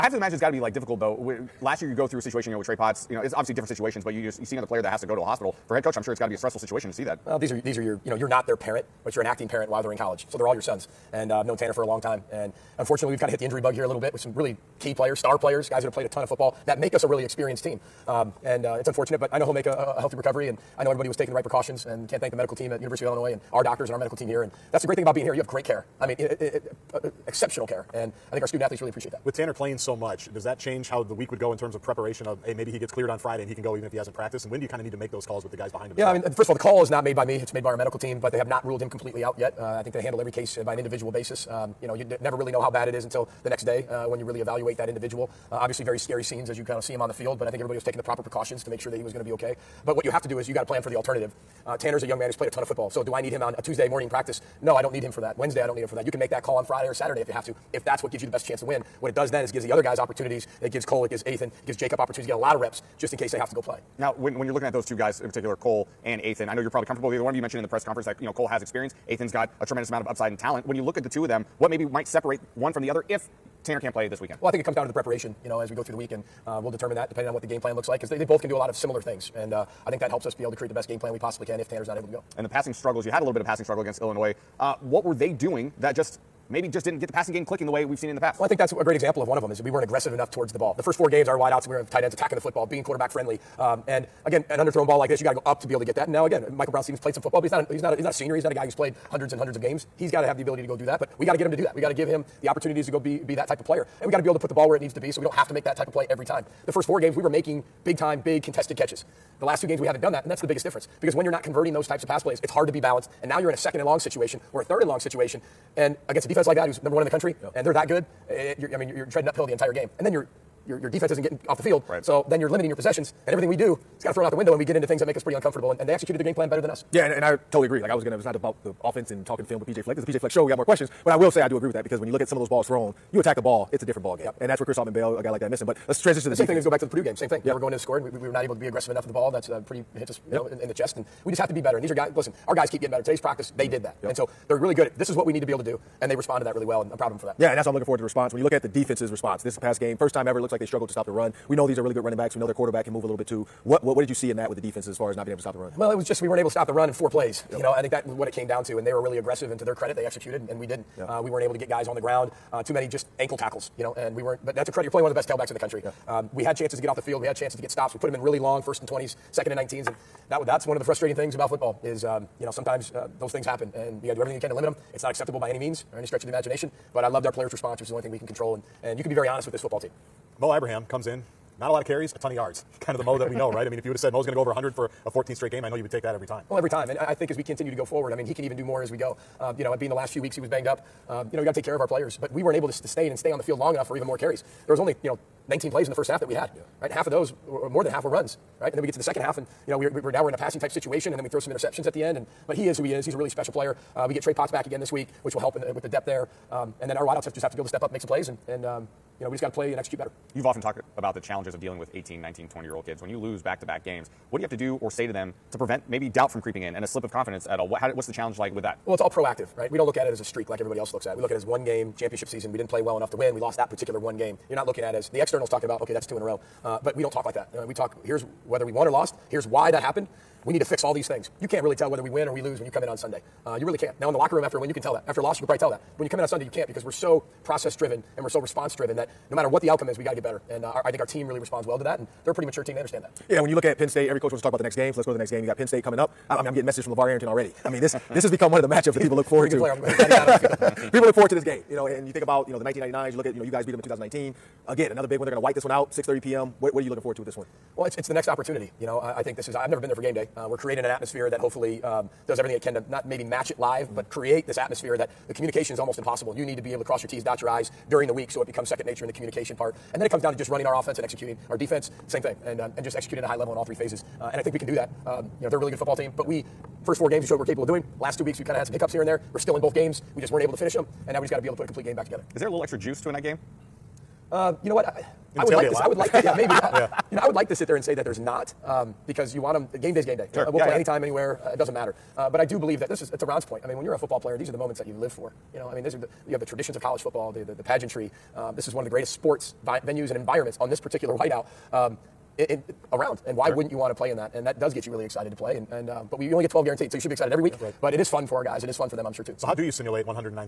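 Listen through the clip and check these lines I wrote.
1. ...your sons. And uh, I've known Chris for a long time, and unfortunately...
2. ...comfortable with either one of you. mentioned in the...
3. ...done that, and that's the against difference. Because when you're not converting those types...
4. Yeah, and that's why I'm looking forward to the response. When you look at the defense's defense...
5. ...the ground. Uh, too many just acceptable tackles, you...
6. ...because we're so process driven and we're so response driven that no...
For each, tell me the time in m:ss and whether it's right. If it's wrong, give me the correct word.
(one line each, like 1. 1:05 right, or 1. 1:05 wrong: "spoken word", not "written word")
1. 0:10 wrong: "Tanner", not "Chris"
2. 1:06 right
3. 1:50 wrong: "biggest", not "against"
4. 2:27 wrong: "response", not "defense"
5. 2:41 wrong: "ankle", not "acceptable"
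6. 3:56 right.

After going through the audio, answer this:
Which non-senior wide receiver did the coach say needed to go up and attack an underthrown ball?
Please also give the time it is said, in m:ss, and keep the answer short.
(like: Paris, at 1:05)
Michael Brown-Stephens, at 1:36.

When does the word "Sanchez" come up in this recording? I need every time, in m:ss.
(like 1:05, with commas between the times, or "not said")
not said.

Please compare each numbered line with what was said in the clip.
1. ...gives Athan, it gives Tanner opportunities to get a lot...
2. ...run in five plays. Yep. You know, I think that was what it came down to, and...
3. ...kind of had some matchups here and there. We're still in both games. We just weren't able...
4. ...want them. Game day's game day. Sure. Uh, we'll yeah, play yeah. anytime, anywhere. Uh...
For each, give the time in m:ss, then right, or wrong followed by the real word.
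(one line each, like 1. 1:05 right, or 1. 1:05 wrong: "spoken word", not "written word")
1. 1:01 wrong: "Jacob", not "Tanner"
2. 2:36 wrong: "four", not "five"
3. 4:38 wrong: "hiccups", not "matchups"
4. 4:49 right.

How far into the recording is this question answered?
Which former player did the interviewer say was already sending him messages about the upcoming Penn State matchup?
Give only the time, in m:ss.
4:06.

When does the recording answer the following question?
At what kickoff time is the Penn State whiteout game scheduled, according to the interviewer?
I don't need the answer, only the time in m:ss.
4:15.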